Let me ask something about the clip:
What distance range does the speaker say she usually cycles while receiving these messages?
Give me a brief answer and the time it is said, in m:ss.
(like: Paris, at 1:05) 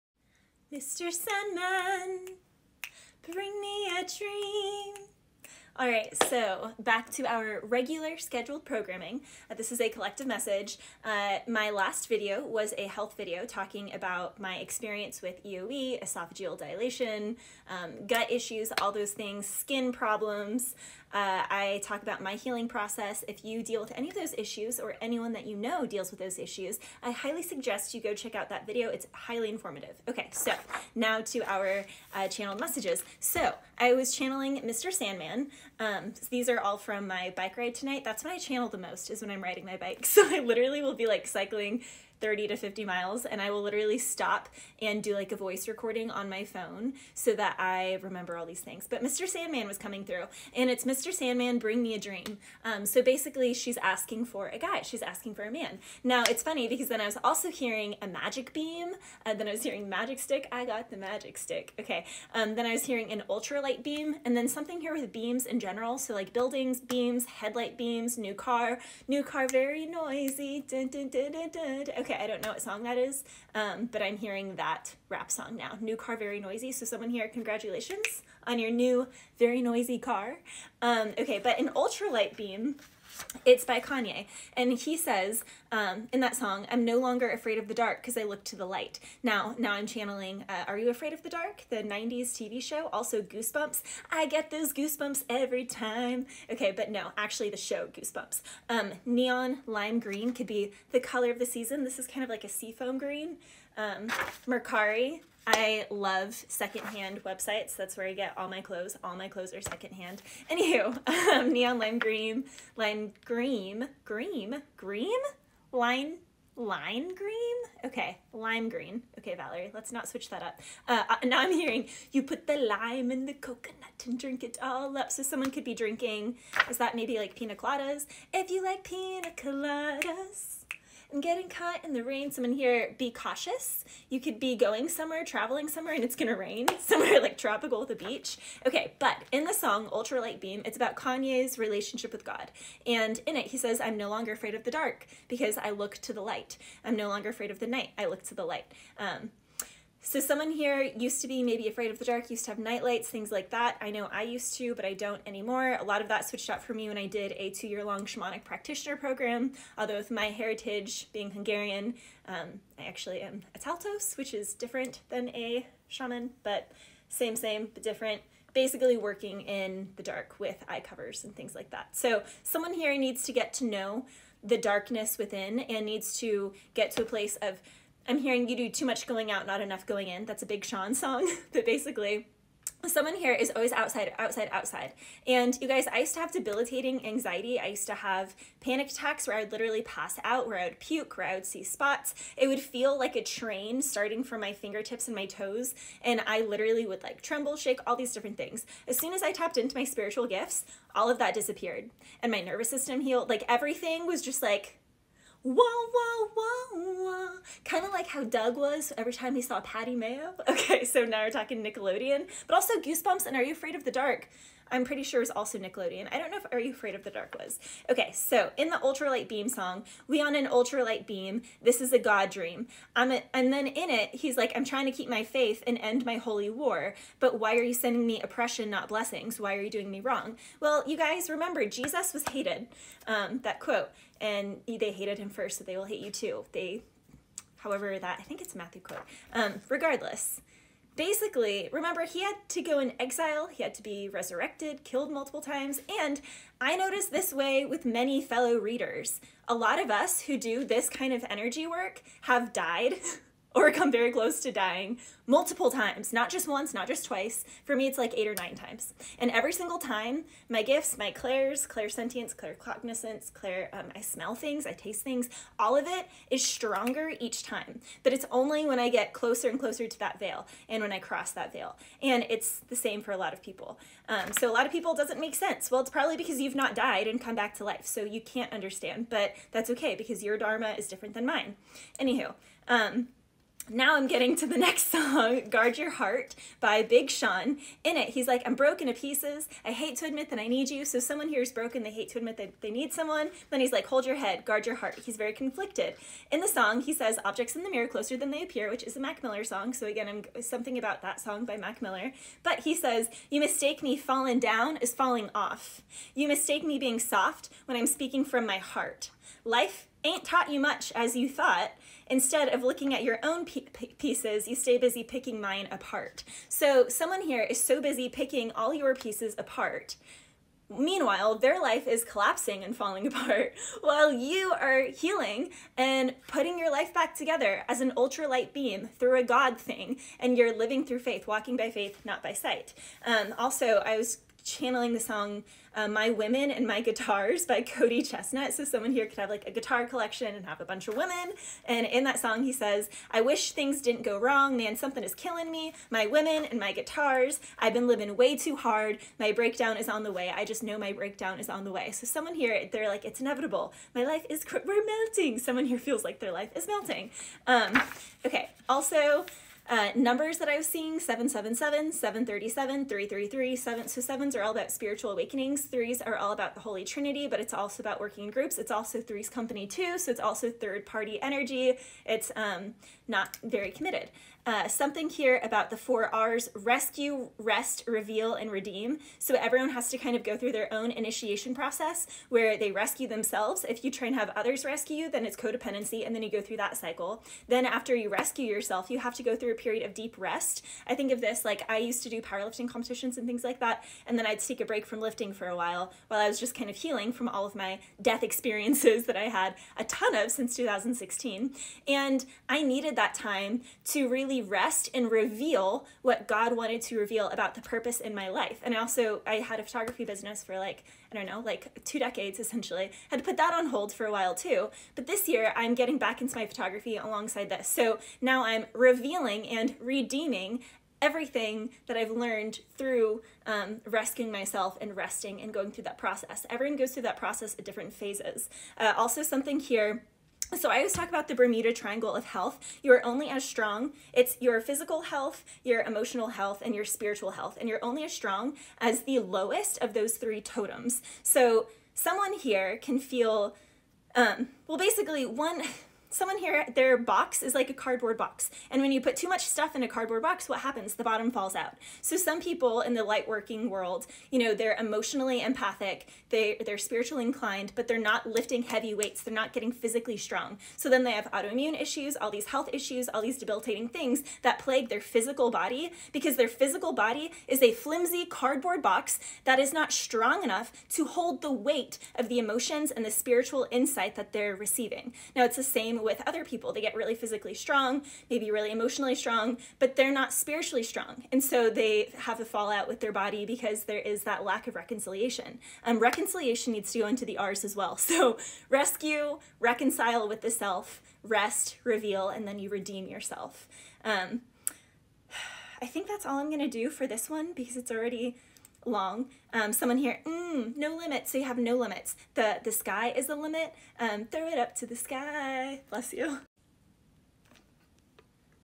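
30 to 50 miles, at 0:42.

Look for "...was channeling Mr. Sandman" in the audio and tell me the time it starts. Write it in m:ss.
0:33.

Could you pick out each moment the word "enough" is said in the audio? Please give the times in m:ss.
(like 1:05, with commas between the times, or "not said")
2:59, 7:50.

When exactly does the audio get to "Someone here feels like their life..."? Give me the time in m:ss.
5:55.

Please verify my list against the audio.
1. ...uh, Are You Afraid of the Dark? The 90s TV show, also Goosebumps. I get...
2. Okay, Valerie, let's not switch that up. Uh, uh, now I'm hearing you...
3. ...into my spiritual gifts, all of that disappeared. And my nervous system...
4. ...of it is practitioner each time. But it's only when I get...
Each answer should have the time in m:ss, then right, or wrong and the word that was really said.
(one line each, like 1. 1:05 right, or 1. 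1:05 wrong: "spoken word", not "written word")
1. 1:30 right
2. 1:59 right
3. 3:19 right
4. 4:25 wrong: "stronger", not "practitioner".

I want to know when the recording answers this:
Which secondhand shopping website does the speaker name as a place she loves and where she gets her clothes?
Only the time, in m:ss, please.
1:44.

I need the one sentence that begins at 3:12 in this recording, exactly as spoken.
It would feel like a train starting from my fingertips and my toes.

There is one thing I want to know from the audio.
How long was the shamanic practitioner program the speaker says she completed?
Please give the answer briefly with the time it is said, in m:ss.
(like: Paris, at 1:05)
2 years, at 2:37.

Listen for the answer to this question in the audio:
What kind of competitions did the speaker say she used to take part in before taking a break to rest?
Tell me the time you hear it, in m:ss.
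6:32.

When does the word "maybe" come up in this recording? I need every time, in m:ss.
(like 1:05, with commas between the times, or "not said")
2:06, 2:31, 7:58.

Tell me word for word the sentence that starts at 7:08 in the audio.
Uh, also something here so I always talk about the Bermuda Triangle of health.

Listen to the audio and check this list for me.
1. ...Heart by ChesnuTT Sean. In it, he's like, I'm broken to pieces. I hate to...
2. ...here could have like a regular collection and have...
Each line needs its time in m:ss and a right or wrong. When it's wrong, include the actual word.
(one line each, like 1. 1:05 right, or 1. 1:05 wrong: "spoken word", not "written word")
1. 4:45 wrong: "Big", not "ChesnuTT"
2. 5:38 wrong: "guitar", not "regular".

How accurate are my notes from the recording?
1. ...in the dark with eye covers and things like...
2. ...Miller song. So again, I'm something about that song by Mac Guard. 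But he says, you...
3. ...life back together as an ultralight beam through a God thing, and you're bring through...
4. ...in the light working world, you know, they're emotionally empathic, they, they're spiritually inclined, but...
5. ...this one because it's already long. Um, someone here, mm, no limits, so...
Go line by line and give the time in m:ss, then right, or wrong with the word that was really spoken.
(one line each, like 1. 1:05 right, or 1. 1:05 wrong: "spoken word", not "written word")
1. 2:49 right
2. 4:59 wrong: "Miller", not "Guard"
3. 5:26 wrong: "living", not "bring"
4. 7:32 right
5. 8:17 right.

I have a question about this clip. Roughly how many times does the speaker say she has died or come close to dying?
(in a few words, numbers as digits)
8 or 9.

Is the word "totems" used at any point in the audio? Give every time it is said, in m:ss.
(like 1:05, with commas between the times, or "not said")
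7:20.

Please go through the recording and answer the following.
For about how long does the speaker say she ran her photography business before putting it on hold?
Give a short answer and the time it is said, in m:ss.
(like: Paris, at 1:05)
2 decades, at 6:51.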